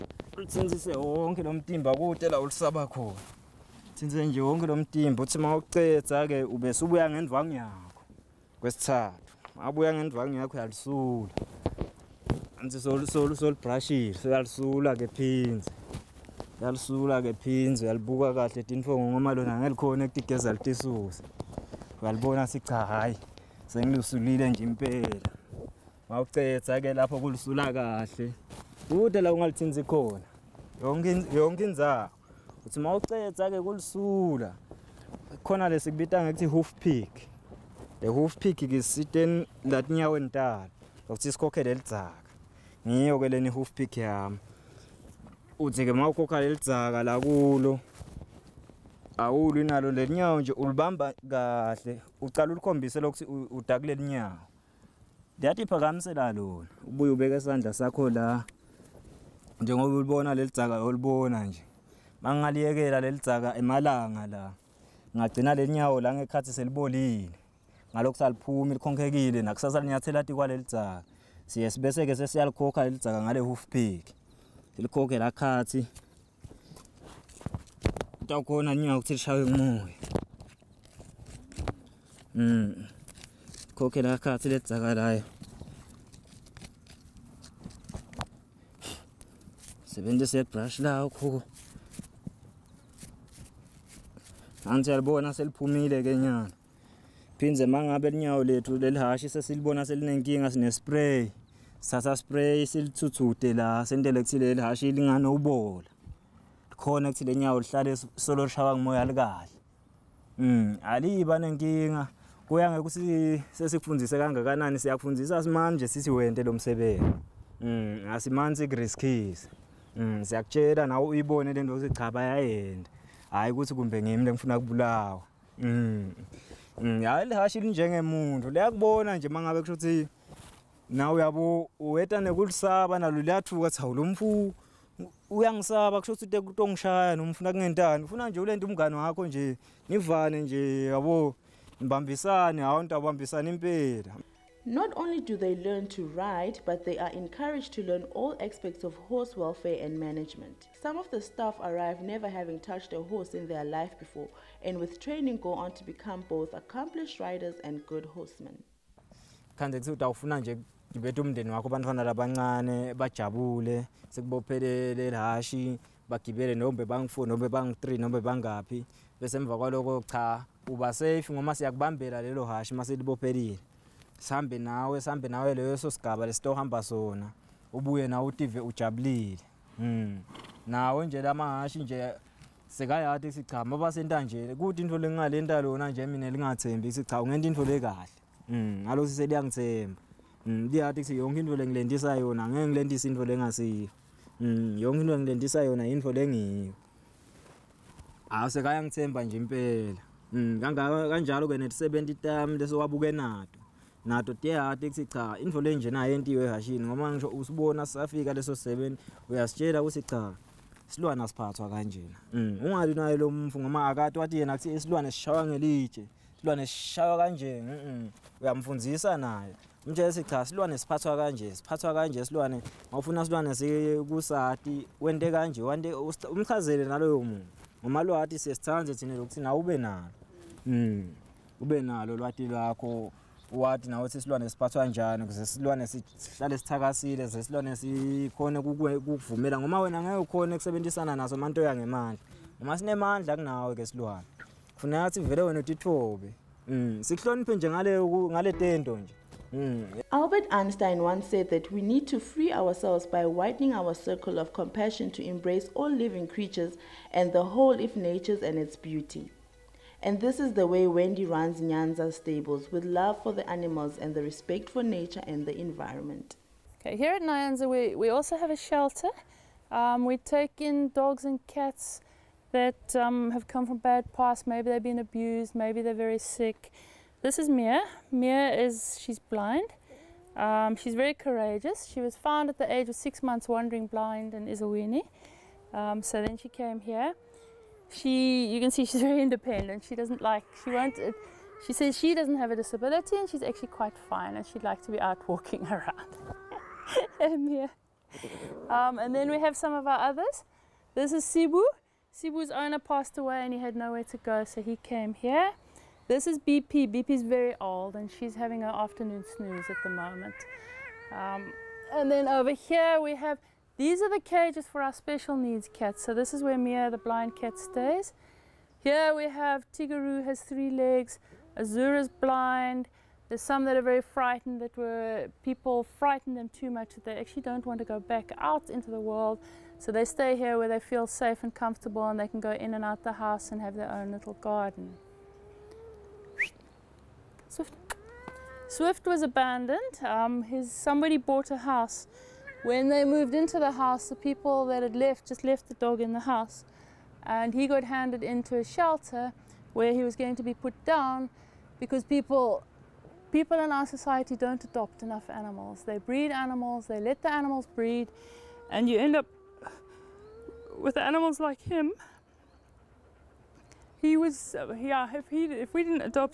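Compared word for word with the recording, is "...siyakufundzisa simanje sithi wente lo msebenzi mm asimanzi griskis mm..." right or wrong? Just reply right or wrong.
right.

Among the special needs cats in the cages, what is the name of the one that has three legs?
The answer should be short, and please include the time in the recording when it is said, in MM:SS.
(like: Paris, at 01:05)
Tigaru, at 05:19.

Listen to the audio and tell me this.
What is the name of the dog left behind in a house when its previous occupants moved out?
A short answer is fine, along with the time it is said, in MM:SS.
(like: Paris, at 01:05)
Swift, at 05:38.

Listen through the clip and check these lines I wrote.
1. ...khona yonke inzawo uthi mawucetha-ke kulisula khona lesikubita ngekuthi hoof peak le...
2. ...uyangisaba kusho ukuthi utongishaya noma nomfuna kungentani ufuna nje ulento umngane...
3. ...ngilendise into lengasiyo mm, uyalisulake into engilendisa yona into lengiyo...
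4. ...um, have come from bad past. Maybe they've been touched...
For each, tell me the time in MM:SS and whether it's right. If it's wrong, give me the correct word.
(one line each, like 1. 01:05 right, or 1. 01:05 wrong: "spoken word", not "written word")
1. 00:29 right
2. 02:15 right
3. 03:12 wrong: "yonke", not "uyalisulake"
4. 04:32 wrong: "abused", not "touched".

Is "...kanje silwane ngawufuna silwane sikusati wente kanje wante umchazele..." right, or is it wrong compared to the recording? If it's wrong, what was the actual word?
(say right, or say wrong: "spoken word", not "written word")
right.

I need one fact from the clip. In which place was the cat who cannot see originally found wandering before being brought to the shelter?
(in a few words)
Ezulwini.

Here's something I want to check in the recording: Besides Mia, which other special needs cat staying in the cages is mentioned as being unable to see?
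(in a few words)
Azura.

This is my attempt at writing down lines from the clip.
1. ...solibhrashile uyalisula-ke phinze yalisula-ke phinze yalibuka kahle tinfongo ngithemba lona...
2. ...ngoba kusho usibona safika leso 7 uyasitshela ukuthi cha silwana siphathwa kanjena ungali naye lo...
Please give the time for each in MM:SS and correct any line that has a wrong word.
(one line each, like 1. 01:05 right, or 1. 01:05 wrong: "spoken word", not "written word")
1. 00:13 wrong: "ngoba", not "ngithemba"
2. 03:26 wrong: "ngisho", not "kusho".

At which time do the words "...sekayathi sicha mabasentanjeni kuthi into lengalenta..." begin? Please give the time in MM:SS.
03:02.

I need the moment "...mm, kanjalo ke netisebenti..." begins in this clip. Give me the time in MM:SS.
03:20.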